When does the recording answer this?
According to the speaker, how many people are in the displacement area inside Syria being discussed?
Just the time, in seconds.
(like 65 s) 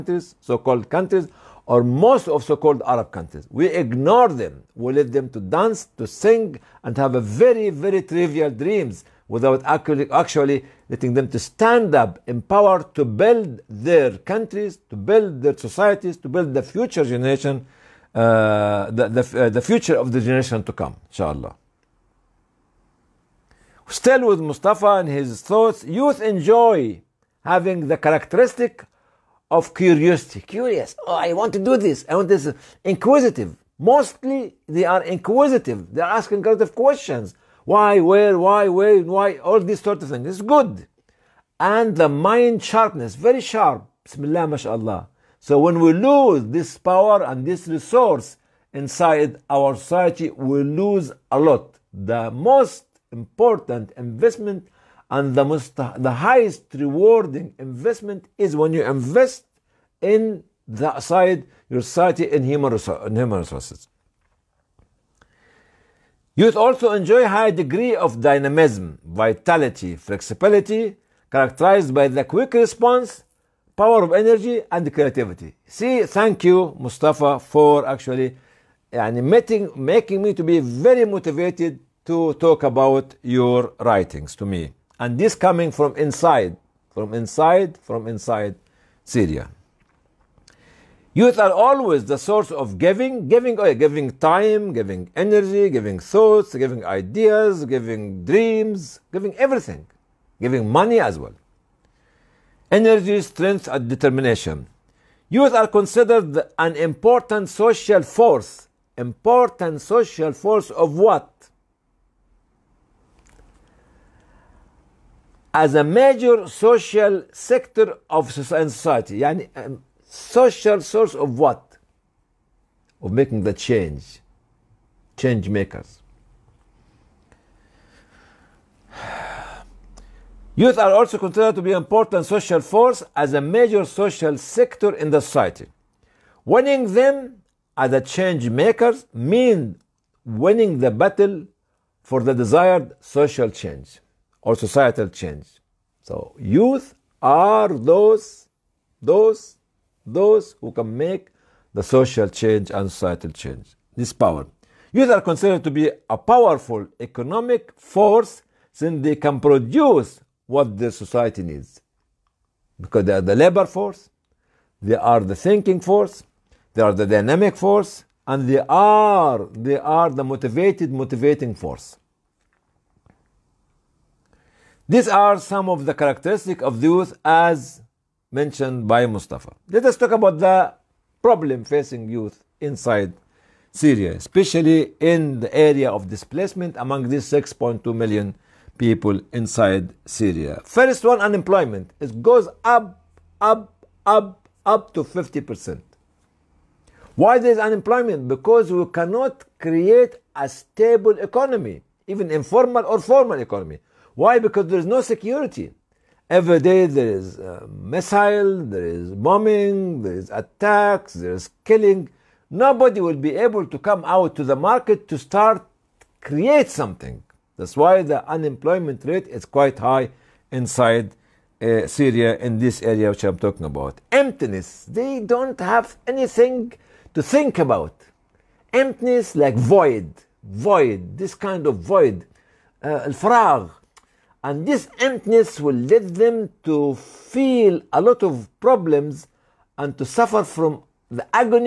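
187 s.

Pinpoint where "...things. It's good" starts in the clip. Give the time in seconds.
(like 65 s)
40 s.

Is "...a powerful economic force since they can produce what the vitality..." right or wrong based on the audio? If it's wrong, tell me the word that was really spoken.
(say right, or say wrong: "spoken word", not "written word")
wrong: "society", not "vitality".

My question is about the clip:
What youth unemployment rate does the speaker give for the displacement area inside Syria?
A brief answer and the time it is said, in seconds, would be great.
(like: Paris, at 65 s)
50%, at 195 s.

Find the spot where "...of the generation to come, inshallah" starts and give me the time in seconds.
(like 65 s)
19 s.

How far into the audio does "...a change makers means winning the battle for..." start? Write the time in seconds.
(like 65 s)
137 s.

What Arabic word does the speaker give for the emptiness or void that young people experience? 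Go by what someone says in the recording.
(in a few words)
al-faragh.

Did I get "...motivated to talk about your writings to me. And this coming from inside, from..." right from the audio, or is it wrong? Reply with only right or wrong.
right.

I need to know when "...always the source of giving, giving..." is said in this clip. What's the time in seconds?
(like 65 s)
91 s.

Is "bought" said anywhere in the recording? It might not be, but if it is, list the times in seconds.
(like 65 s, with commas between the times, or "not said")
not said.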